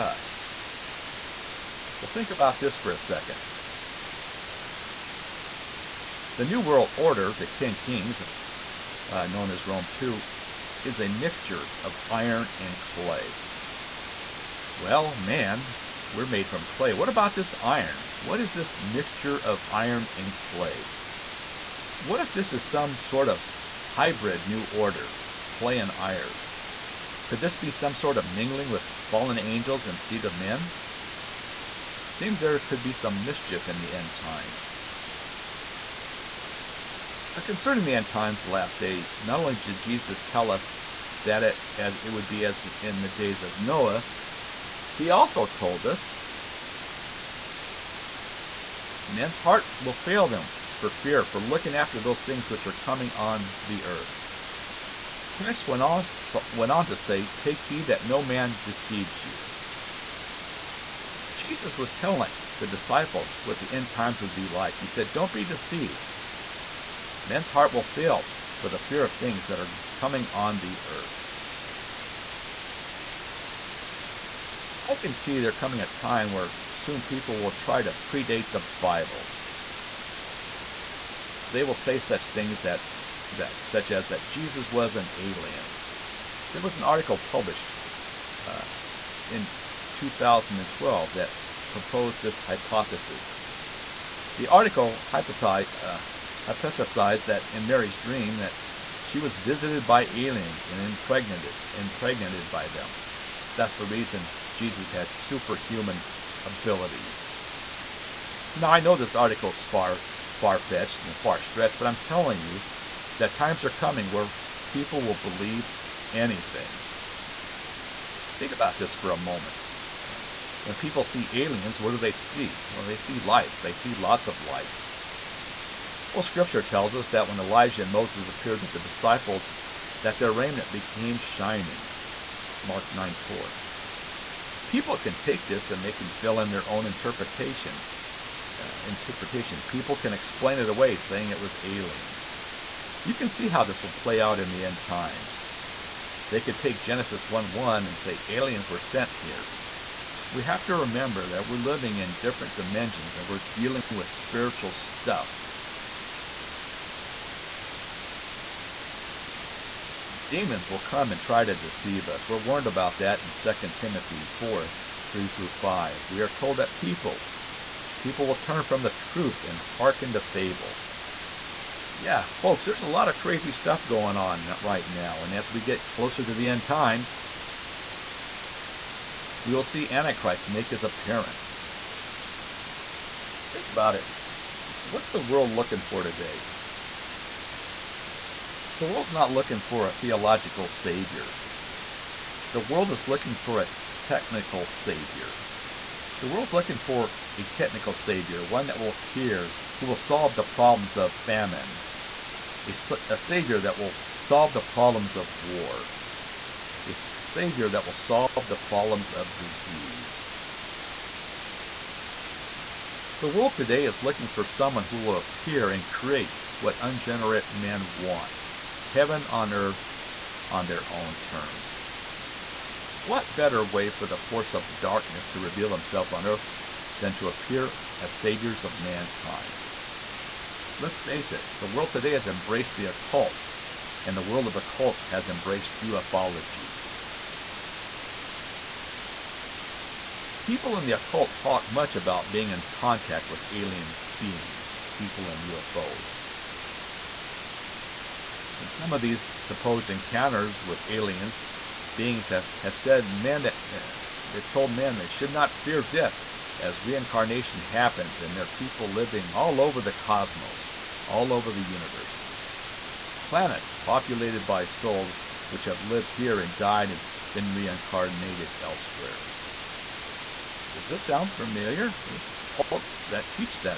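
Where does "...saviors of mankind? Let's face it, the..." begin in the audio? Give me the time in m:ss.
3:48.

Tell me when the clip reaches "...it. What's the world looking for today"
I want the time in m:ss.
3:03.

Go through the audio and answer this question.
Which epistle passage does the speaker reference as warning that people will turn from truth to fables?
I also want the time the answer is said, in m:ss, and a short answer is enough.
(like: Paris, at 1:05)
2 Timothy 4:3-5, at 2:43.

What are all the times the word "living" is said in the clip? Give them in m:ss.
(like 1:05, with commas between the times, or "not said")
2:31, 4:18.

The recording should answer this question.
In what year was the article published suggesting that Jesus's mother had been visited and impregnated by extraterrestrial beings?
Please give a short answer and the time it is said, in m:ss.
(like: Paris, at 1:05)
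2012, at 1:29.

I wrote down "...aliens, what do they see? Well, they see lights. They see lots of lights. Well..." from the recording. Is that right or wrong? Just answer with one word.
right.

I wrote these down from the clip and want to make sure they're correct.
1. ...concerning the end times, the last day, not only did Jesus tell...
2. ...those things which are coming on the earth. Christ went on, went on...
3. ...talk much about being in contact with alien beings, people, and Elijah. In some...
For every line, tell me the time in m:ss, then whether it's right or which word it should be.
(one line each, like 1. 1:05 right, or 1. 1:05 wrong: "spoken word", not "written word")
1. 0:37 right
2. 0:52 right
3. 4:01 wrong: "UFOs", not "Elijah".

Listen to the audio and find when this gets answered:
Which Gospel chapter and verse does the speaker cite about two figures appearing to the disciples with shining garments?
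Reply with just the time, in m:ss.
2:12.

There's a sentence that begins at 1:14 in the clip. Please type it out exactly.
I can see there coming a time where soon people will try to predate the Bible.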